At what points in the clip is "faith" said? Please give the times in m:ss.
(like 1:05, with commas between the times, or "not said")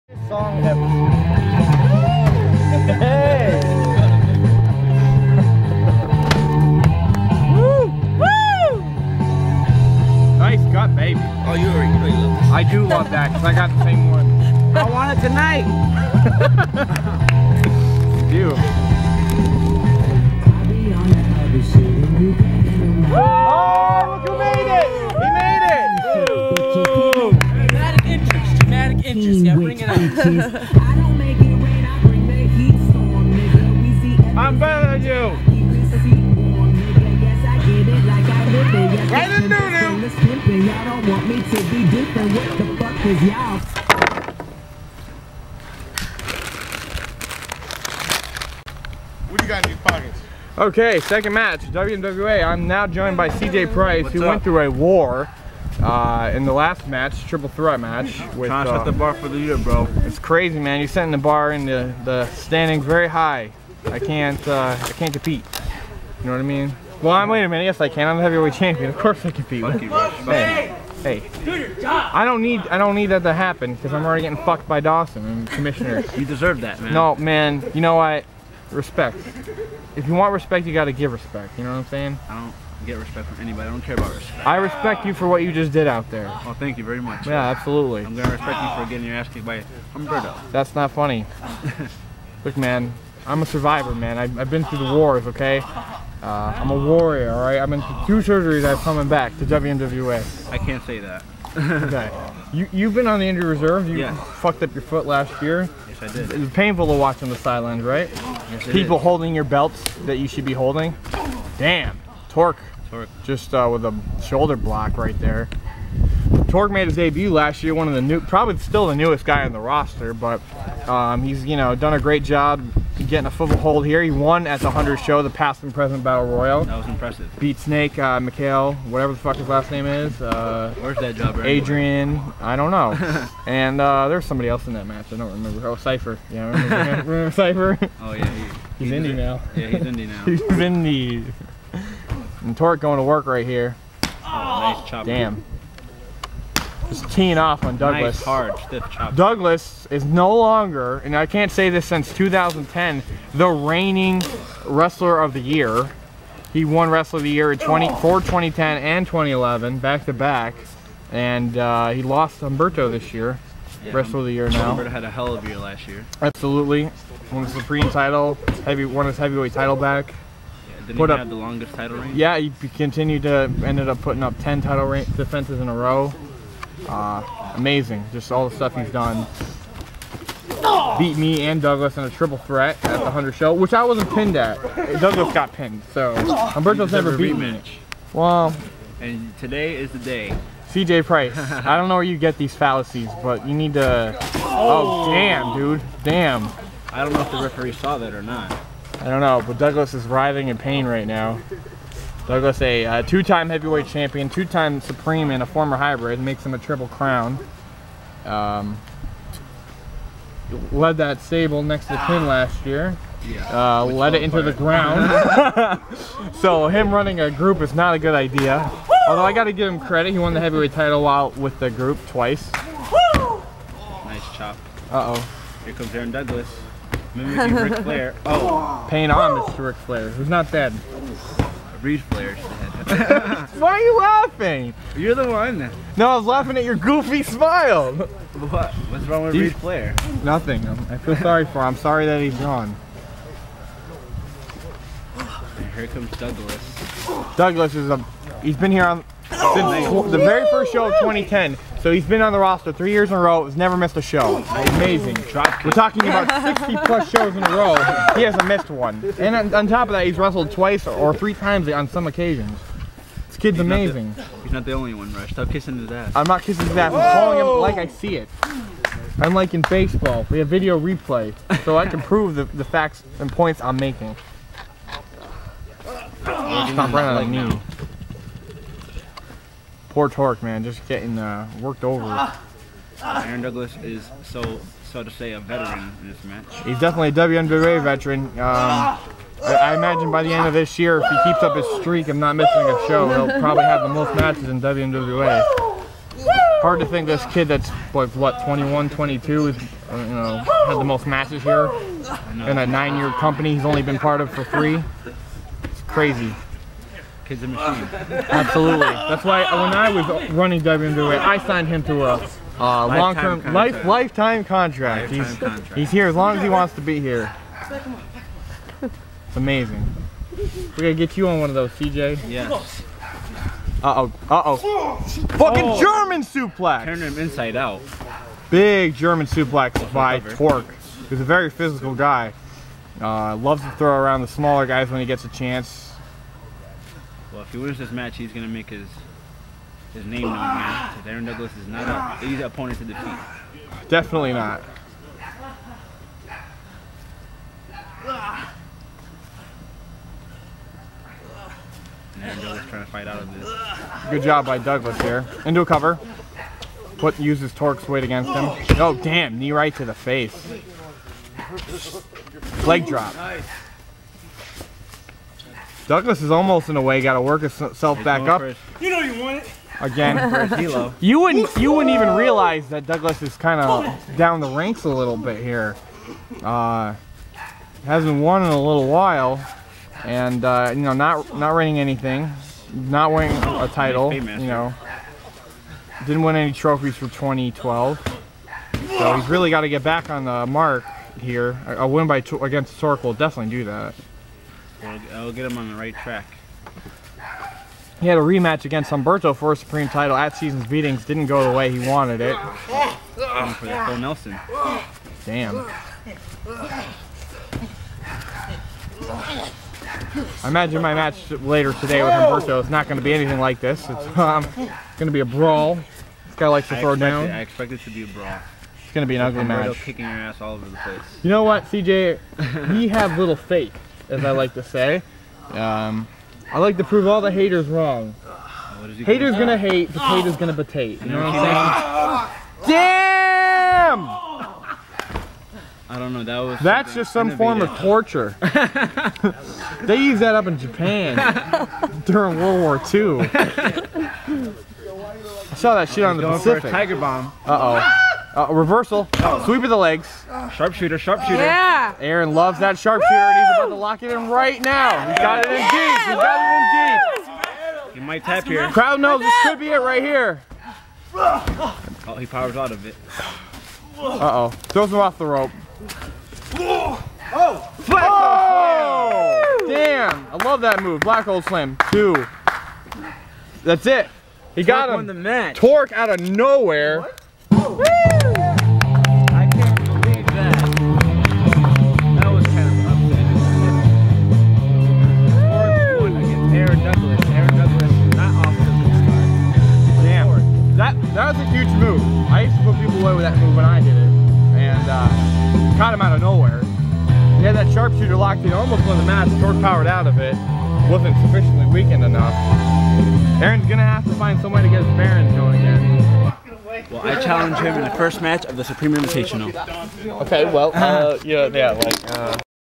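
7:03.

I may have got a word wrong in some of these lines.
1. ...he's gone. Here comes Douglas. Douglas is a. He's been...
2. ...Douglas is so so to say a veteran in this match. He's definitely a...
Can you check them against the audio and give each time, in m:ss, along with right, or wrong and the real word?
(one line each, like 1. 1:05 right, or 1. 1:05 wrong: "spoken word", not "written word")
1. 4:02 right
2. 4:43 right.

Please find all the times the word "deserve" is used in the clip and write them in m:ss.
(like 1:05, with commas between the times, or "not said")
1:16.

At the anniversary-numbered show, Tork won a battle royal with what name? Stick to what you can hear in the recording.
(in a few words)
past and present battle royal.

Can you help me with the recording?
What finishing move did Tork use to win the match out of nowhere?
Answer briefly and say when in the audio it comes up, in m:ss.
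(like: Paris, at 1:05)
Black hole slam, at 7:51.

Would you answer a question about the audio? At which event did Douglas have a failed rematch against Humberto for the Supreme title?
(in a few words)
Season's Beatings.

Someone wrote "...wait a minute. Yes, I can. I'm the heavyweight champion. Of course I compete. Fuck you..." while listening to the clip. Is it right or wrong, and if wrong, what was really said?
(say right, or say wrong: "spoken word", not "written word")
right.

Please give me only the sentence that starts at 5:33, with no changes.
Uh, loves to throw around the smaller guys when he gets a chance.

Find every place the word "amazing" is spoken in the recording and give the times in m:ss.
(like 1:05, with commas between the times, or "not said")
2:57, 4:14, 4:23, 5:19.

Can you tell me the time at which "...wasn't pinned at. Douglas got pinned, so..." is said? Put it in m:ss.
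3:03.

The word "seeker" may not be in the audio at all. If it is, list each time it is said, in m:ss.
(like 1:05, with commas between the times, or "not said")
not said.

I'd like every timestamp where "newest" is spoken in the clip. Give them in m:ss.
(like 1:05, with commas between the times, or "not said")
1:58.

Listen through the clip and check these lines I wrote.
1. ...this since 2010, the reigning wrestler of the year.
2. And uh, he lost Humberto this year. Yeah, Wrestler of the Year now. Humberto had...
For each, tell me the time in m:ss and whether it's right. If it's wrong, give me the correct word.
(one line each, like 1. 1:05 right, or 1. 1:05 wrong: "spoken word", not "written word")
1. 2:31 right
2. 2:41 right.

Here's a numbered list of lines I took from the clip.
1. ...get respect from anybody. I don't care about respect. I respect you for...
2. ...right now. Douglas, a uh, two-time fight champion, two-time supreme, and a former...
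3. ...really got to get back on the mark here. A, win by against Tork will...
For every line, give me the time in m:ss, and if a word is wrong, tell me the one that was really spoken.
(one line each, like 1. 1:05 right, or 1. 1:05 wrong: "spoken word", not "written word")
1. 1:22 right
2. 3:20 wrong: "heavyweight", not "fight"
3. 6:29 right.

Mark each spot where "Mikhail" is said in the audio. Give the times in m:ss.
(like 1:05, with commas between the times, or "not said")
2:08.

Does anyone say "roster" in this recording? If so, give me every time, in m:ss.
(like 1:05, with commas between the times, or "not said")
1:59, 4:12.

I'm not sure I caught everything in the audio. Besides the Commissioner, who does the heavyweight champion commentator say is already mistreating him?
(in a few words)
Dawson.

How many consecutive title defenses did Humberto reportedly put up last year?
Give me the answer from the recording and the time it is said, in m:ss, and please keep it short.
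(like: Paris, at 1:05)
10, at 2:54.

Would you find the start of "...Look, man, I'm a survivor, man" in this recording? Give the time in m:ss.
1:32.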